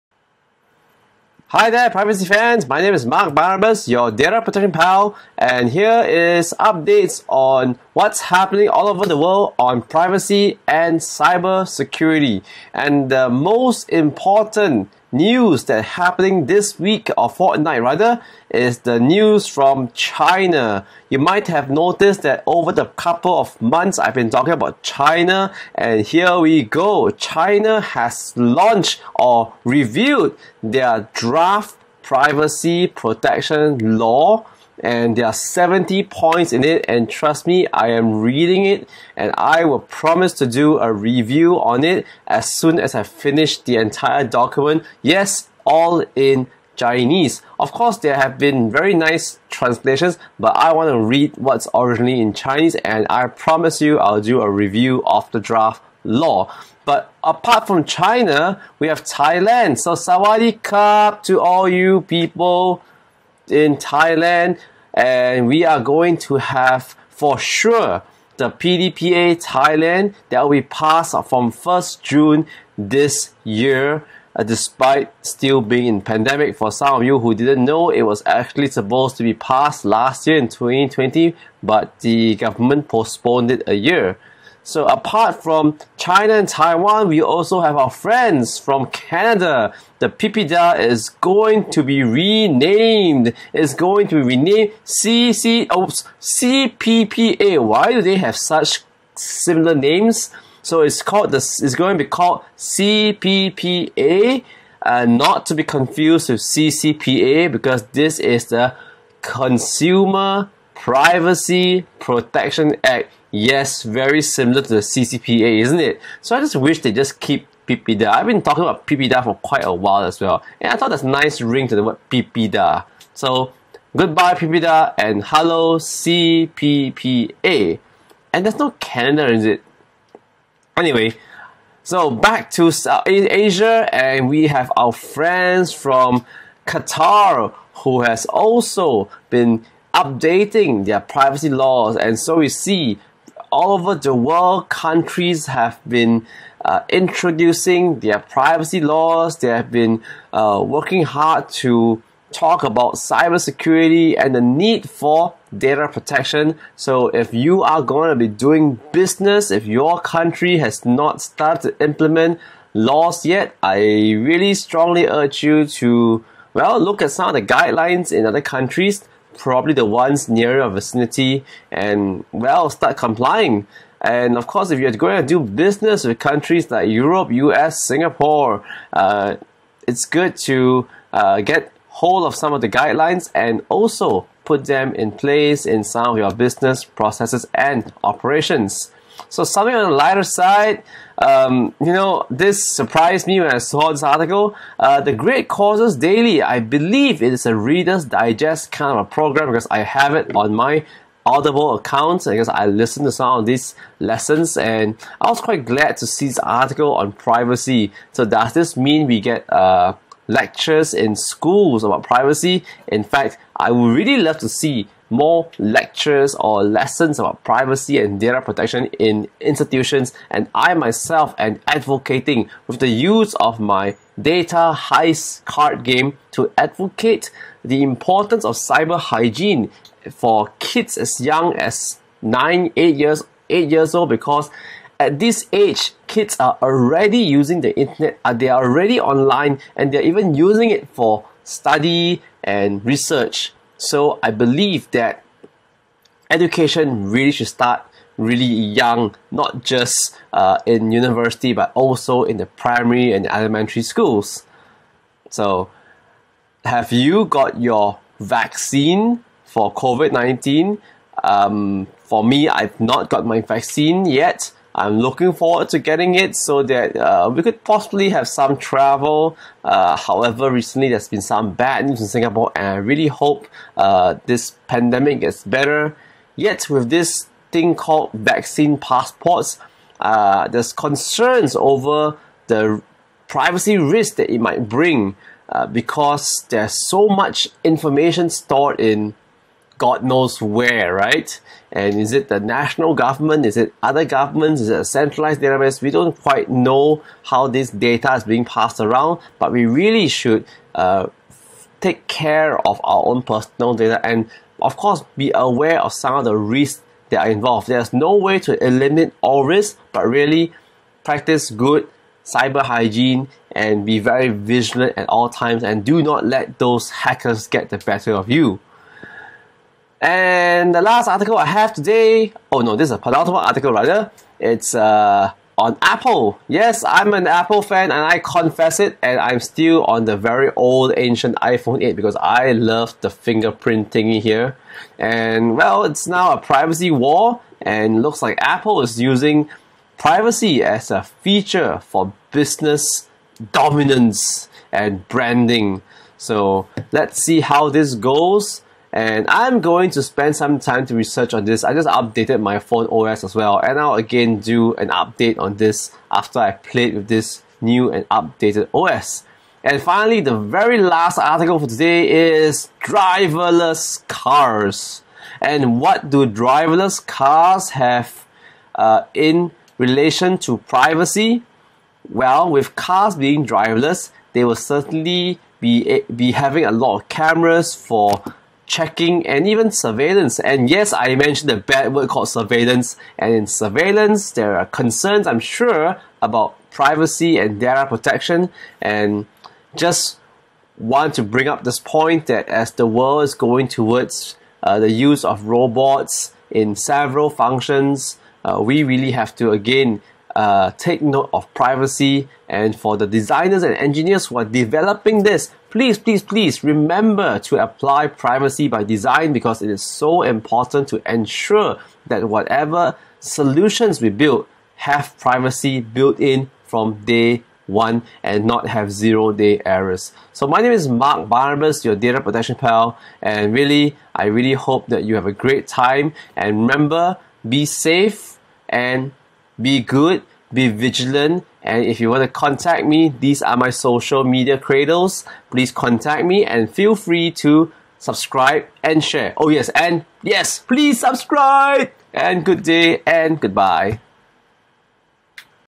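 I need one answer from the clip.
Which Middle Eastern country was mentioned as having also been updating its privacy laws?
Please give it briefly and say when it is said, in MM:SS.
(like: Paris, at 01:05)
Qatar, at 02:16.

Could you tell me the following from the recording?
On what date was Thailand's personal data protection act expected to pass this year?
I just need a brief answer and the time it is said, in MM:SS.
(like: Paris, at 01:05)
1st June, at 01:11.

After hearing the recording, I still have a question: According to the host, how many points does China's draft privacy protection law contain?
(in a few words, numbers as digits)
70.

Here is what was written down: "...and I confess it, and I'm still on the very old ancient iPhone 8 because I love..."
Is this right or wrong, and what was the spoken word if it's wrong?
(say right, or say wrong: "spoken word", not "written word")
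right.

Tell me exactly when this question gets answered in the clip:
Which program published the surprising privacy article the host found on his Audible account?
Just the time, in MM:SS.
03:15.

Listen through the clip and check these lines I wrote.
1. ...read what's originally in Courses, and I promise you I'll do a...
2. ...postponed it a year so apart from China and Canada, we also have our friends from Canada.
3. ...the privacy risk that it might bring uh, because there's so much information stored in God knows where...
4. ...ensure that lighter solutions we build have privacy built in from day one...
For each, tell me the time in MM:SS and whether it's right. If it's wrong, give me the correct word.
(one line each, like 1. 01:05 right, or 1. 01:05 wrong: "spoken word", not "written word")
1. 00:50 wrong: "Chinese", not "Courses"
2. 01:22 wrong: "Taiwan", not "Canada"
3. 04:42 right
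4. 06:51 wrong: "whatever", not "lighter".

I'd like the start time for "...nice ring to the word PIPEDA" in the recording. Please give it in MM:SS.
02:01.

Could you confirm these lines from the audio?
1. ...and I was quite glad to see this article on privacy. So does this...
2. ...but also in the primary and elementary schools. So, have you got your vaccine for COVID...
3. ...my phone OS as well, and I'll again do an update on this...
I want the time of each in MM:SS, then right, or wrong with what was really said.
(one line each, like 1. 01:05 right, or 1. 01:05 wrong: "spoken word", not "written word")
1. 03:24 right
2. 04:11 right
3. 05:52 right.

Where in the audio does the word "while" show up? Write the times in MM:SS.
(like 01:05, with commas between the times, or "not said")
01:59.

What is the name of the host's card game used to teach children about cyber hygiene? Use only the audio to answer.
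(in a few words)
Data Heist.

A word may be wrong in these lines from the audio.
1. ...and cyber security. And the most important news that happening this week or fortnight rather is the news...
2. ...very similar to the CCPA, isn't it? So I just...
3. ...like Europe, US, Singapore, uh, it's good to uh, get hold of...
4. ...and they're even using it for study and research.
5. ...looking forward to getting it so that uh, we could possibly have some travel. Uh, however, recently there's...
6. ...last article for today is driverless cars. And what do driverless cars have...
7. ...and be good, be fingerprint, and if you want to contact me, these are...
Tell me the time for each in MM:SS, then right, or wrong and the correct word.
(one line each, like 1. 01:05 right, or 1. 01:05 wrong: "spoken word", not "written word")
1. 00:10 right
2. 01:53 right
3. 02:56 right
4. 03:59 right
5. 04:24 right
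6. 06:00 right
7. 07:08 wrong: "vigilant", not "fingerprint".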